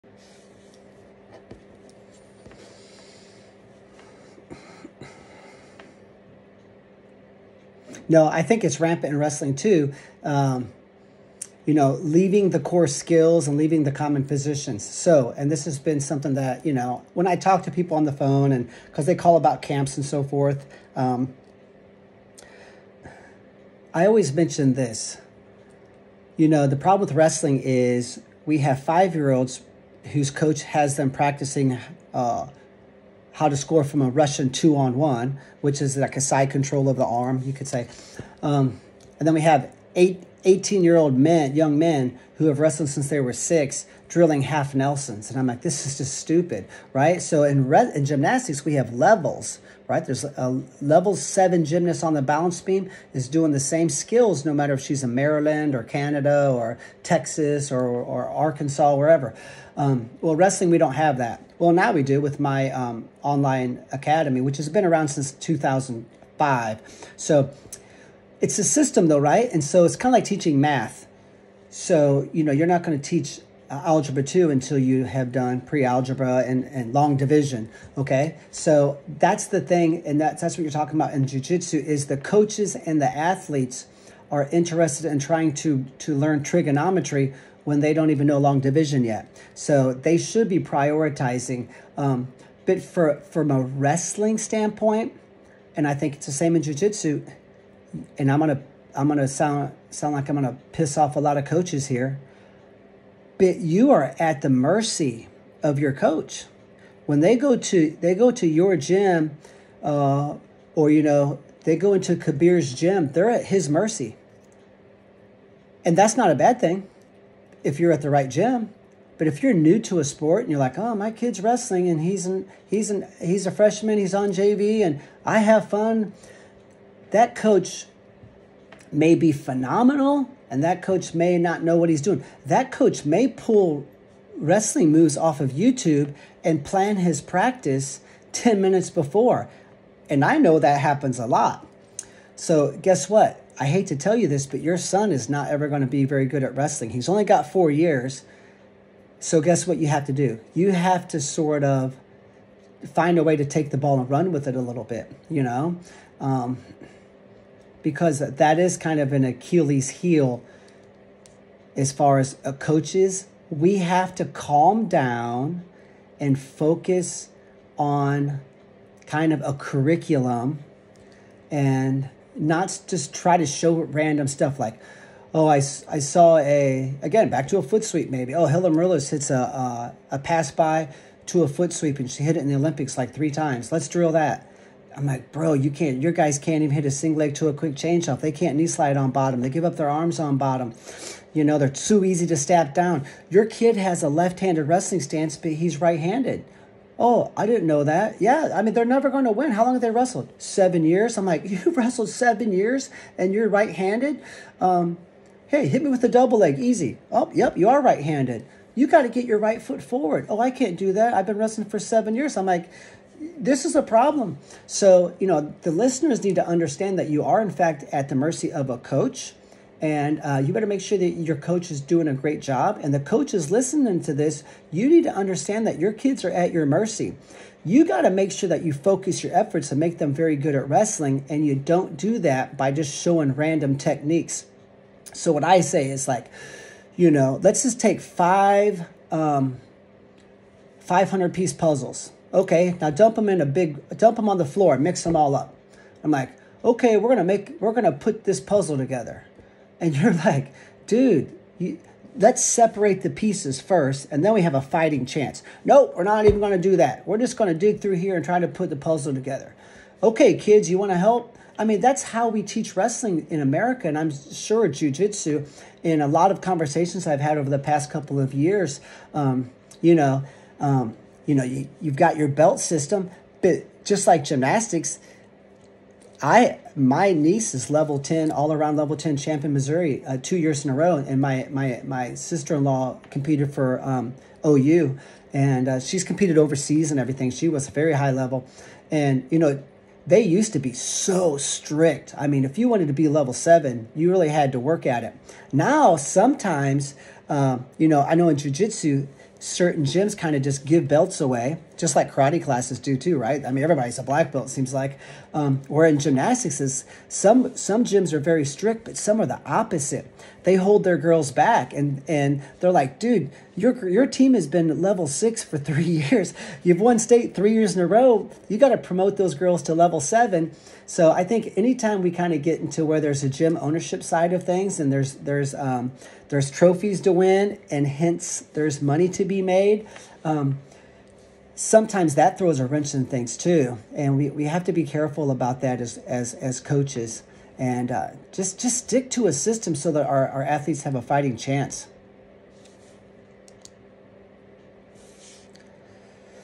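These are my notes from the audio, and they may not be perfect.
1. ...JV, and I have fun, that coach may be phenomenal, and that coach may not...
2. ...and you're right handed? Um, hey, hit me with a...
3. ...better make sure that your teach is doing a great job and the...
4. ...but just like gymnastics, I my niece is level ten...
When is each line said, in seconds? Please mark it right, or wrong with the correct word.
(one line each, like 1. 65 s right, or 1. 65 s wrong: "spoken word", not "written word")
1. 124 s right
2. 203 s right
3. 220 s wrong: "coach", not "teach"
4. 273 s right.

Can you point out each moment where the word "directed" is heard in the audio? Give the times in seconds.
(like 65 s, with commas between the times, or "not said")
not said.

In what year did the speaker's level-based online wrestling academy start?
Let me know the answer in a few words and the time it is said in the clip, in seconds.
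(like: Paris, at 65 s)
2005, at 65 s.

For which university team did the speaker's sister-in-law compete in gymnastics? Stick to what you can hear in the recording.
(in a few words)
OU.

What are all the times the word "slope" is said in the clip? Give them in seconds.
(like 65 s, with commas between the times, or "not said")
not said.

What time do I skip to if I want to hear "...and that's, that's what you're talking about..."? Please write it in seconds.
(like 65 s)
80 s.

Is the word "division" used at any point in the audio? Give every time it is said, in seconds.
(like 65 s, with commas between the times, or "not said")
77 s, 88 s.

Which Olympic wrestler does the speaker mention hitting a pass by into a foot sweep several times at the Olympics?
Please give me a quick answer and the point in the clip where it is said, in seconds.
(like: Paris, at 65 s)
Helen Maroulis, at 178 s.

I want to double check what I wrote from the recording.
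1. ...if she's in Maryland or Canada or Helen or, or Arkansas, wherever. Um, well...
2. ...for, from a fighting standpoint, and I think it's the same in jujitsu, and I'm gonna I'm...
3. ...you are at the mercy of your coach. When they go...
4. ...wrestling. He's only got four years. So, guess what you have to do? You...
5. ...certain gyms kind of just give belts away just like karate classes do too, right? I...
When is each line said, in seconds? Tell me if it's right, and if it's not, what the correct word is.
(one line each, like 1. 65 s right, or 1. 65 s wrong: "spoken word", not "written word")
1. 54 s wrong: "Texas", not "Helen"
2. 92 s wrong: "wrestling", not "fighting"
3. 103 s right
4. 146 s right
5. 299 s right.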